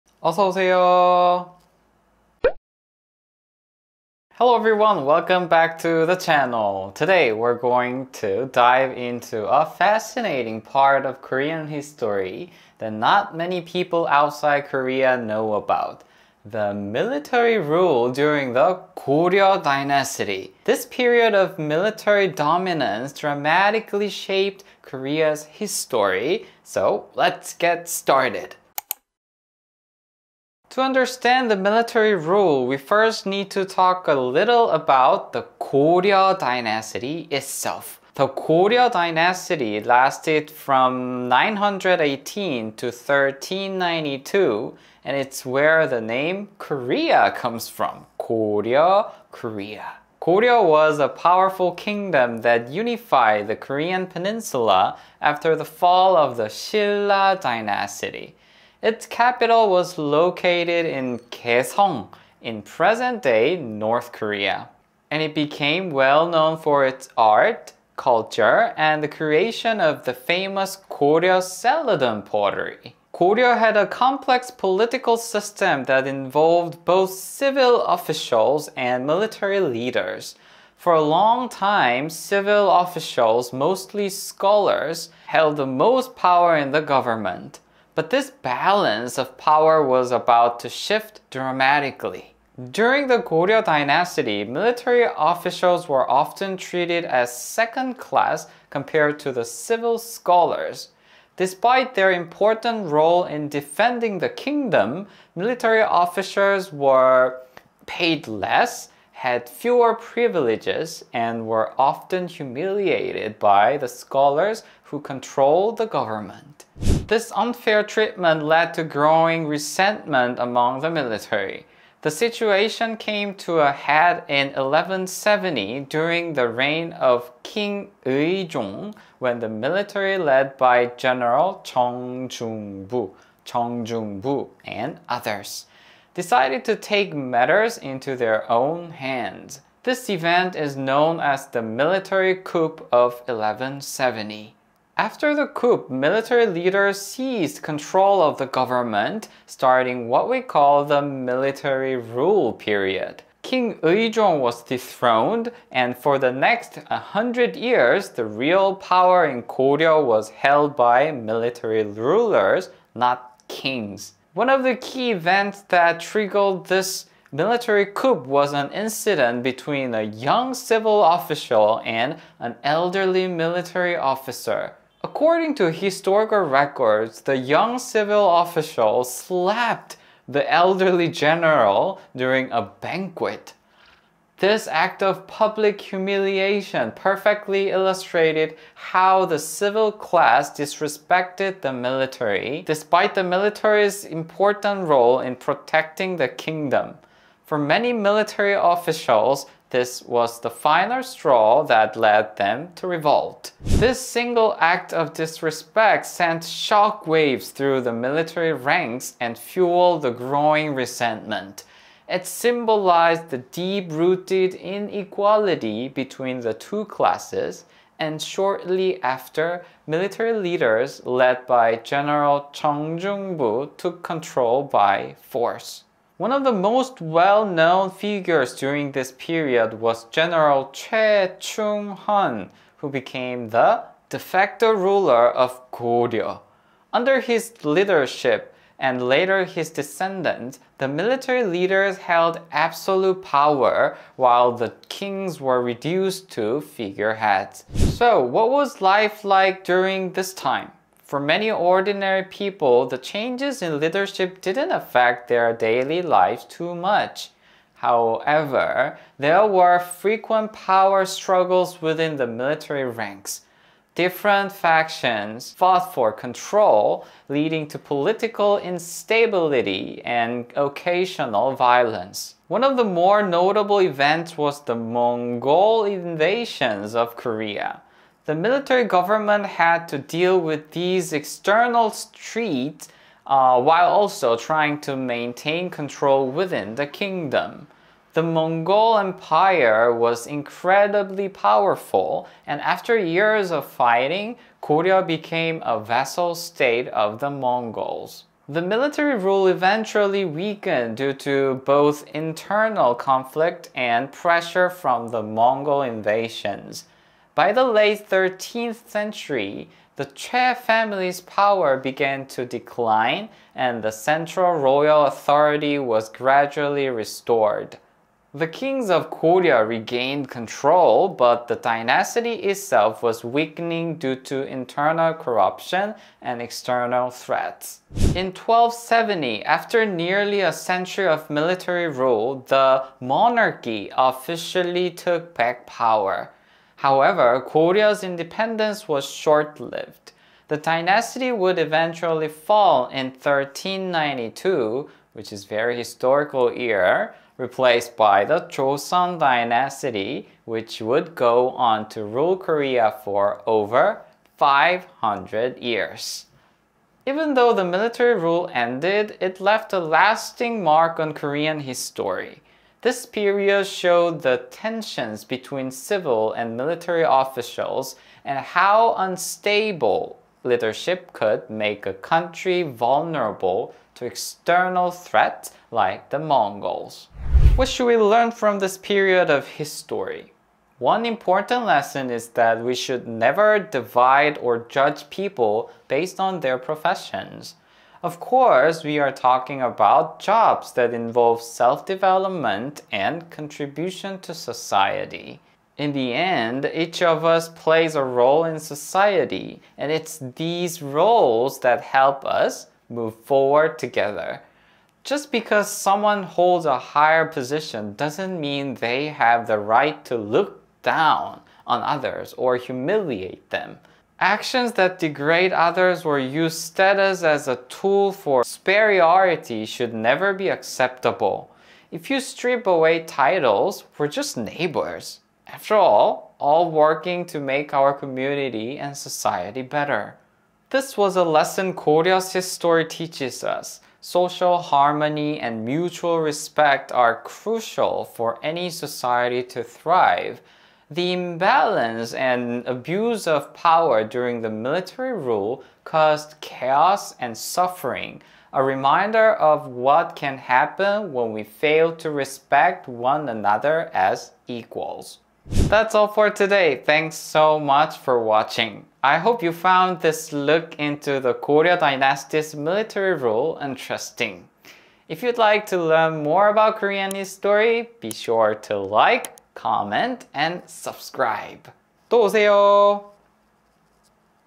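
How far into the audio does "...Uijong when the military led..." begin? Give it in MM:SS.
02:08.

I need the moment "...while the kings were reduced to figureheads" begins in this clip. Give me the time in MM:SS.
04:04.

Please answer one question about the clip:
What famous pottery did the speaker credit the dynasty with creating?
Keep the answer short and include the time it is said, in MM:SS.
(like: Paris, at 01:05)
Koryo Celadon, at 01:10.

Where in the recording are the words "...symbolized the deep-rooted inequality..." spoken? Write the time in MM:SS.
03:32.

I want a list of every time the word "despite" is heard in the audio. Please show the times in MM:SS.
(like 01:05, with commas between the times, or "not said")
01:41, 03:12.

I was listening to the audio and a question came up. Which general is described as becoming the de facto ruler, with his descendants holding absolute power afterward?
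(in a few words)
Choi Chung-heon.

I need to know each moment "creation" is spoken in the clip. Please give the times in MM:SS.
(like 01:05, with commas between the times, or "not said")
01:09.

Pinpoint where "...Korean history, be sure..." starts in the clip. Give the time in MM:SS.
07:46.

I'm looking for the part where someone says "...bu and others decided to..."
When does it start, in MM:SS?
02:14.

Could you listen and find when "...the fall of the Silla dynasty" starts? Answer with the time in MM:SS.
00:55.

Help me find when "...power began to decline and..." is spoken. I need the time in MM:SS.
05:11.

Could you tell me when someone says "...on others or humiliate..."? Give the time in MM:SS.
06:51.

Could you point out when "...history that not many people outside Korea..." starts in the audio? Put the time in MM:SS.
00:11.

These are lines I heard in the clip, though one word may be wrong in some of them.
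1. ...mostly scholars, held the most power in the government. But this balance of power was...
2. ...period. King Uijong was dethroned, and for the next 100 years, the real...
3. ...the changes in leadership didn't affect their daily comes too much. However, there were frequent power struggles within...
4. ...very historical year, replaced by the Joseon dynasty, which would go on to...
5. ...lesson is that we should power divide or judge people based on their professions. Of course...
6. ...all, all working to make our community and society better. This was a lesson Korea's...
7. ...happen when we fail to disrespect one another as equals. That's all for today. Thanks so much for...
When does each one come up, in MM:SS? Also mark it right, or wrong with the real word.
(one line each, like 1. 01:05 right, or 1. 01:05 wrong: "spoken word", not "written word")
1. 01:23 right
2. 02:32 right
3. 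04:12 wrong: "lives", not "comes"
4. 05:45 right
5. 06:21 wrong: "never", not "power"
6. 07:05 right
7. 07:30 wrong: "respect", not "disrespect".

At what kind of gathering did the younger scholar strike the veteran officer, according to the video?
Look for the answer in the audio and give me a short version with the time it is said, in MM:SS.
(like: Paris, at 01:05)
A banquet, at 03:02.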